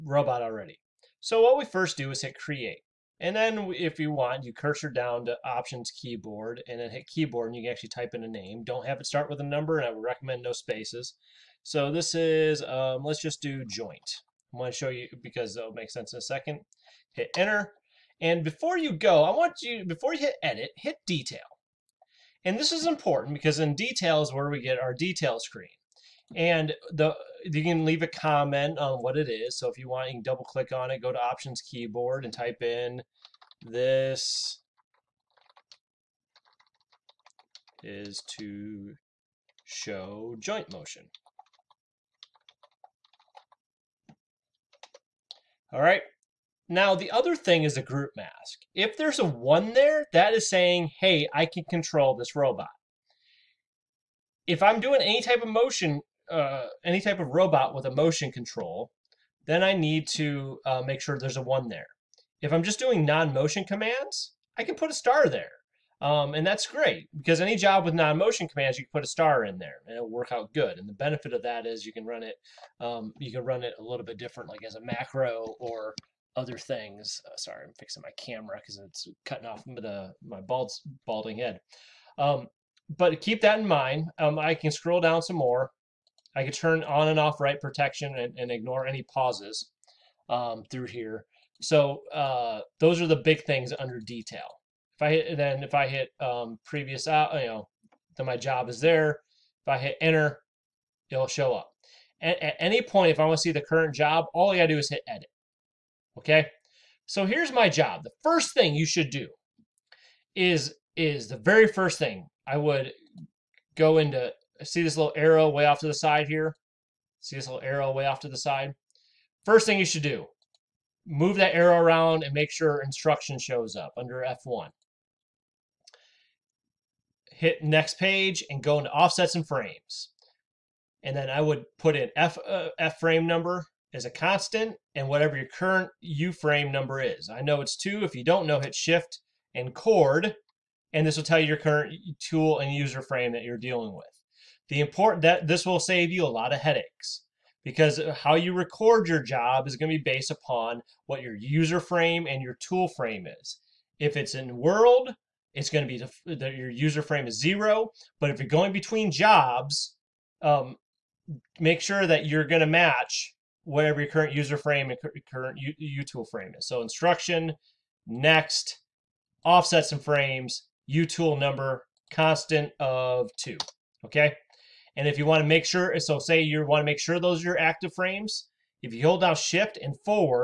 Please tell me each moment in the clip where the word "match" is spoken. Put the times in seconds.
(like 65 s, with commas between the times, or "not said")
162 s.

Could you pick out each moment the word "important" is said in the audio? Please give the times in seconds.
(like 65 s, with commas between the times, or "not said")
22 s, 144 s.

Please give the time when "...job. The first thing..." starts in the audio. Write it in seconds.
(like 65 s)
107 s.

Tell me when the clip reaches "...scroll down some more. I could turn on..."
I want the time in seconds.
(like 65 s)
84 s.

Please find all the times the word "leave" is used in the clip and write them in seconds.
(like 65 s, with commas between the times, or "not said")
27 s.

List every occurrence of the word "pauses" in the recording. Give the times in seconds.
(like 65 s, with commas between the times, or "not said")
89 s.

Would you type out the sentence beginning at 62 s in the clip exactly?
If I'm just doing non-motion commands, I can put a star there.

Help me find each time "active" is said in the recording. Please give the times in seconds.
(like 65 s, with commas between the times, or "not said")
177 s.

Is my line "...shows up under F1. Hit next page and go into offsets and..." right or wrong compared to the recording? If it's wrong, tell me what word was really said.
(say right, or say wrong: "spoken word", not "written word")
right.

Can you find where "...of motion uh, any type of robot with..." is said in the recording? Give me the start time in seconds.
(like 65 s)
55 s.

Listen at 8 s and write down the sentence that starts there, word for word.
Don't have it start with a number and I would recommend no spaces.